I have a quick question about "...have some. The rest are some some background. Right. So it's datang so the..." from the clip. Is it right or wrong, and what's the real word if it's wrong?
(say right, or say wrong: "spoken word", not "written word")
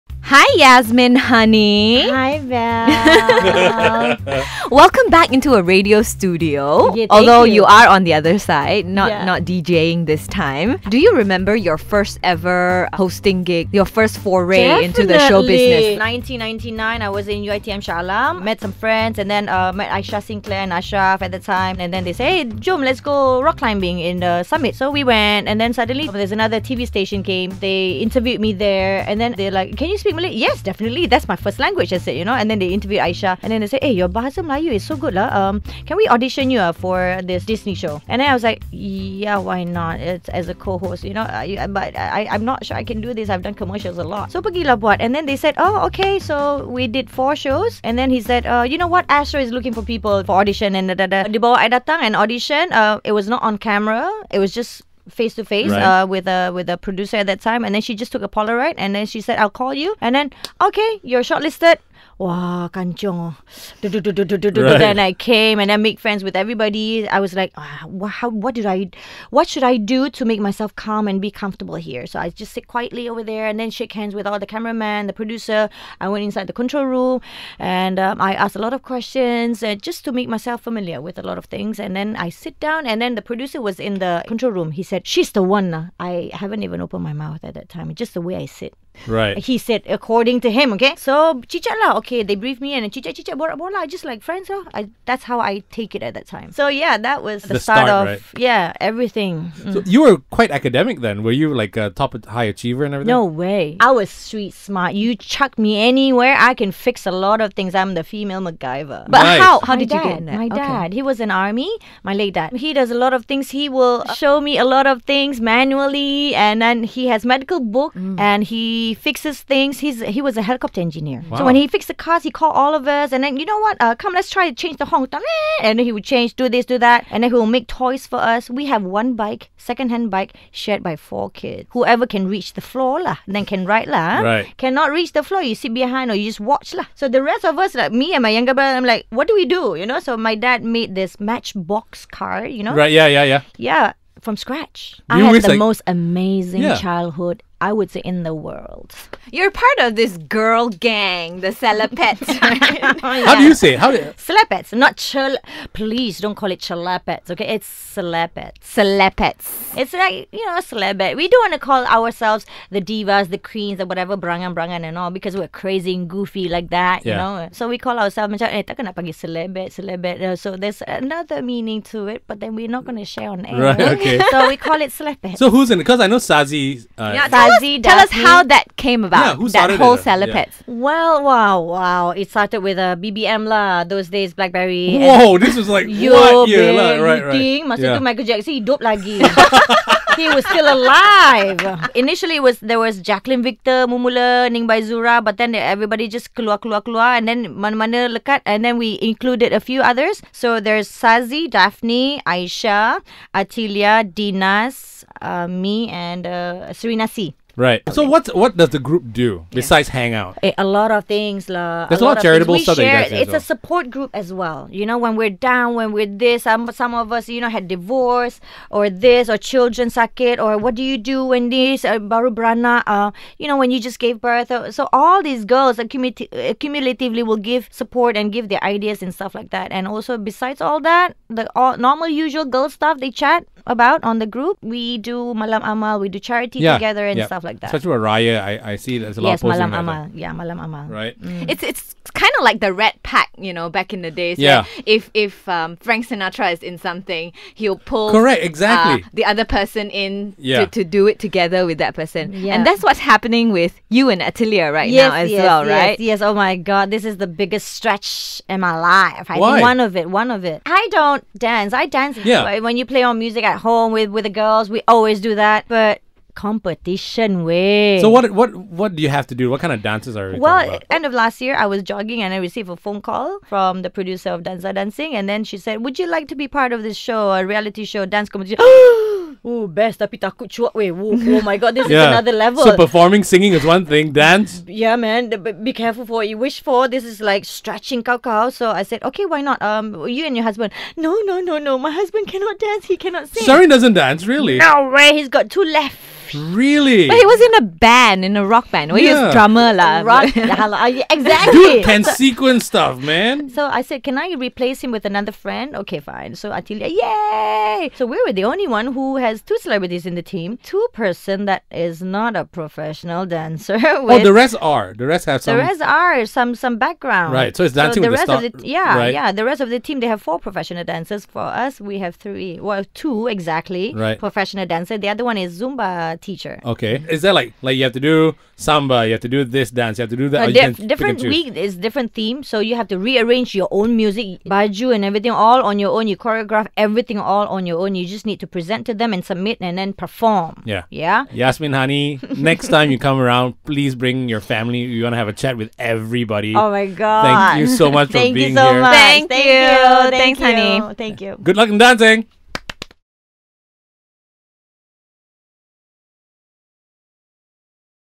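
wrong: "dancing", not "datang".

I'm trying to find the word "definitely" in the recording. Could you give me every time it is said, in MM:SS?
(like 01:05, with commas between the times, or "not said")
00:14, 00:30.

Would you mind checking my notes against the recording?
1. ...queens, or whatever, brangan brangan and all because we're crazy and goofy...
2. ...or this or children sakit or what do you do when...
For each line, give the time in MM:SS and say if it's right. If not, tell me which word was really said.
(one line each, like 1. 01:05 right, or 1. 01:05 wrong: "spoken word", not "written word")
1. 02:43 right
2. 03:38 right.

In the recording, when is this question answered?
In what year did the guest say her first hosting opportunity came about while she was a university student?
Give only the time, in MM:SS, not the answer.
00:15.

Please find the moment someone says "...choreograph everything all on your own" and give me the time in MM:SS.
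05:36.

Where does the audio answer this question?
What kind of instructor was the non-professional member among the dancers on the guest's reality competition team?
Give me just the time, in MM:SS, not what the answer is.
05:25.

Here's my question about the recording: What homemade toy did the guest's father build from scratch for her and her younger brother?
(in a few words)
Matchbox car.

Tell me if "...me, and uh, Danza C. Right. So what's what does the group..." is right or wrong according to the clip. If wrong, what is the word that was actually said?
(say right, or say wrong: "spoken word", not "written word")
wrong: "Serena", not "Danza".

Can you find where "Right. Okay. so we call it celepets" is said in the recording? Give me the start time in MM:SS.
02:53.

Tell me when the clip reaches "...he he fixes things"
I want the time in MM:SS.
01:58.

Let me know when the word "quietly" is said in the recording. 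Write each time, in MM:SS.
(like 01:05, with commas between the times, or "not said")
01:12.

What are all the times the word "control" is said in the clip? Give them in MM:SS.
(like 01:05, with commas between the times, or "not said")
01:16, 01:24.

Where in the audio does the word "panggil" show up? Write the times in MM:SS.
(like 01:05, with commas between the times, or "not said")
02:48.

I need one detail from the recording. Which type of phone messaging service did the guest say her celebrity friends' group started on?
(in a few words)
BBM.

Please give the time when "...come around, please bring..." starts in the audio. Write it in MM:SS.
05:42.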